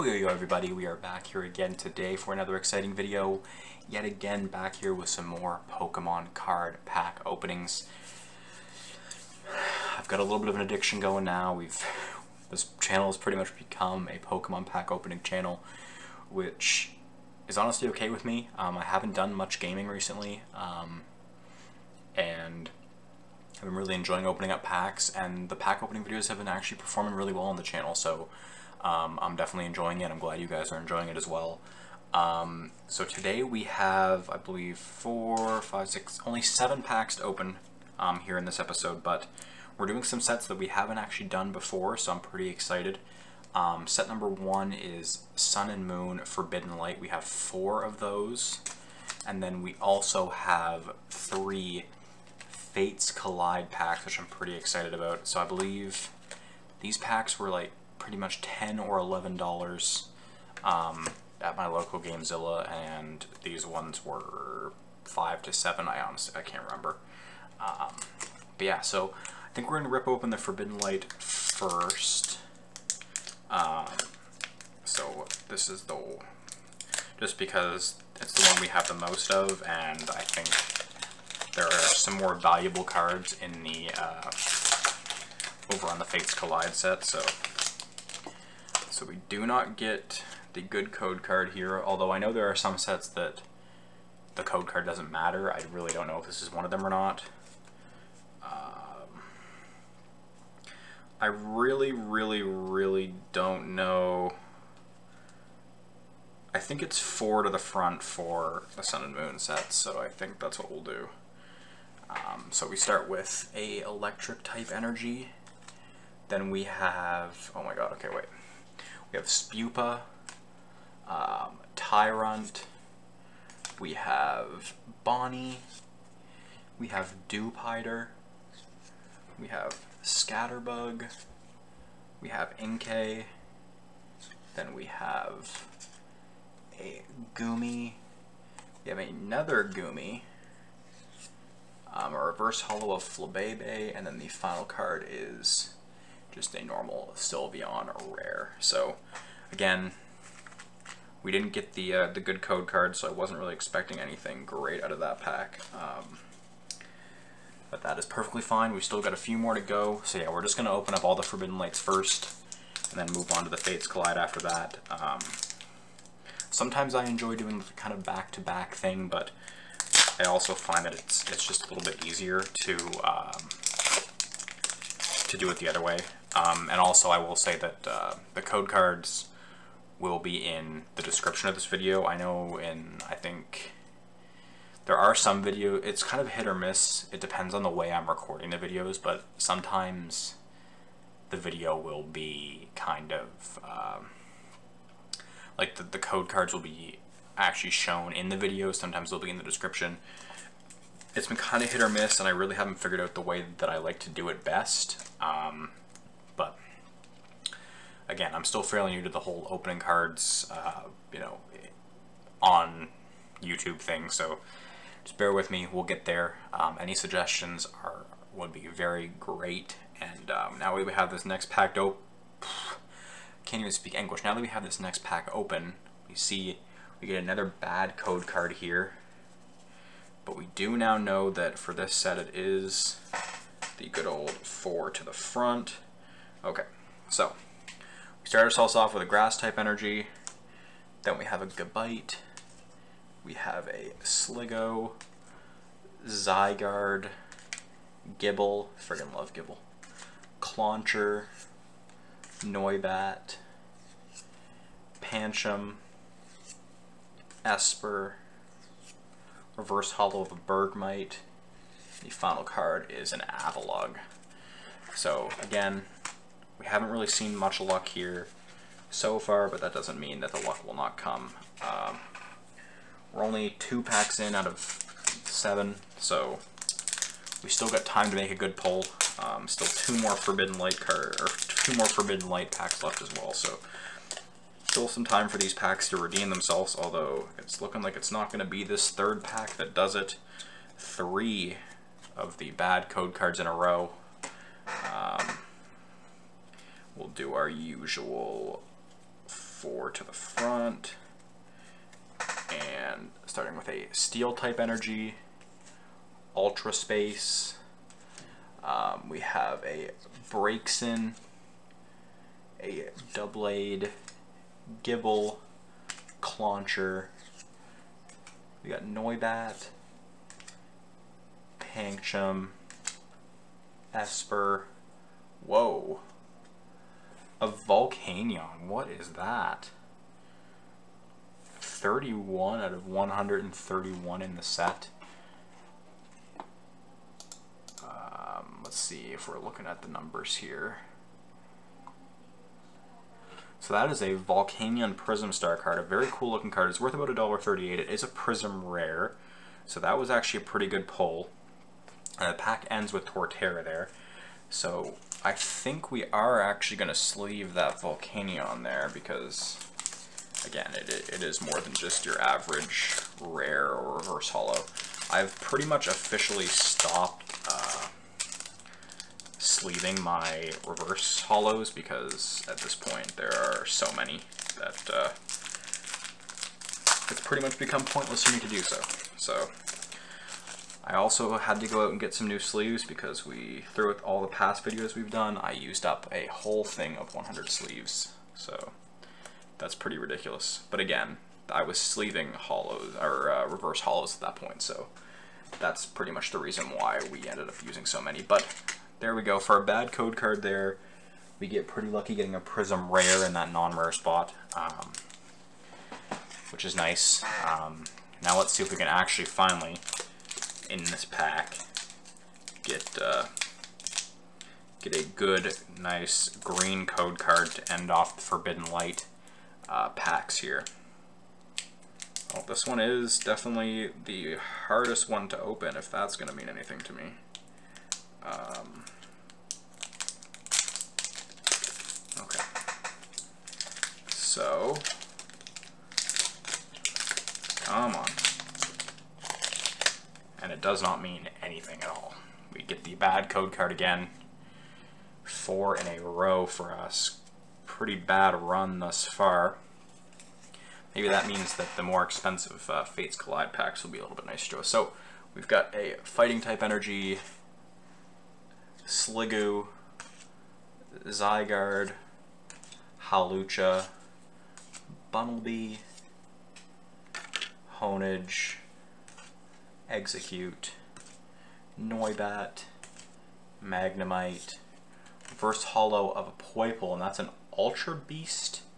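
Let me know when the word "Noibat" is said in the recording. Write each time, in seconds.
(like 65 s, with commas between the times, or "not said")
252 s, 318 s, 471 s.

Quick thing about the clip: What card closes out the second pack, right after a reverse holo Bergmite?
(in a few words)
Avalugg.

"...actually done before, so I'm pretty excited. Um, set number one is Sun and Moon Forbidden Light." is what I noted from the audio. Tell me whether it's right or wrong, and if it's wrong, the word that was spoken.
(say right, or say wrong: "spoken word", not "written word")
right.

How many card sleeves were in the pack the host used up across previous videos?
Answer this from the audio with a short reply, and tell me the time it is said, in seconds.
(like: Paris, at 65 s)
100, at 387 s.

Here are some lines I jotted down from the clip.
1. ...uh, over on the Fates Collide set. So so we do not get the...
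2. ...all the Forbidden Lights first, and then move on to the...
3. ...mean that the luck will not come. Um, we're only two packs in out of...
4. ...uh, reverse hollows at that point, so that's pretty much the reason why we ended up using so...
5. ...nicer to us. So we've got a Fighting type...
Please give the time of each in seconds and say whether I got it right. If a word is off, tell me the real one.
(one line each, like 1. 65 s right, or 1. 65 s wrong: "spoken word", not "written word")
1. 83 s right
2. 161 s right
3. 269 s right
4. 393 s right
5. 454 s right.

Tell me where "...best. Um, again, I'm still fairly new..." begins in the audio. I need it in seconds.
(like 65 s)
204 s.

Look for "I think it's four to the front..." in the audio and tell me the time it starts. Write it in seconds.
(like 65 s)
106 s.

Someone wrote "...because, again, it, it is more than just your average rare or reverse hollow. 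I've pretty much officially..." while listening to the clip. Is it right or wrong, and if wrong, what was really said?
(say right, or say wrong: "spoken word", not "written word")
right.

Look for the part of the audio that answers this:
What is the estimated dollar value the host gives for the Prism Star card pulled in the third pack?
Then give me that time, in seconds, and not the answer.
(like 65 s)
347 s.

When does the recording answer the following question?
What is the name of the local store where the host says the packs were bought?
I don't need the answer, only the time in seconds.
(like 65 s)
62 s.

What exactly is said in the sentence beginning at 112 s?
Um, so we start with a electric type energy.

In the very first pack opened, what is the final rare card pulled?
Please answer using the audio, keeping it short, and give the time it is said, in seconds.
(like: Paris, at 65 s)
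Sylveon, at 147 s.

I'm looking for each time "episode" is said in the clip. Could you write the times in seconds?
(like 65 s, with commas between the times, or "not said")
38 s.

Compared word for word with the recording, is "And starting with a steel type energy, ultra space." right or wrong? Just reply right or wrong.
right.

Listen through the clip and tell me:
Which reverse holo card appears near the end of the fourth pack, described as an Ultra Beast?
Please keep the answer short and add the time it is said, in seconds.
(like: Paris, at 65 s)
Poipole, at 476 s.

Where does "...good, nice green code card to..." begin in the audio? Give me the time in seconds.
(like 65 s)
415 s.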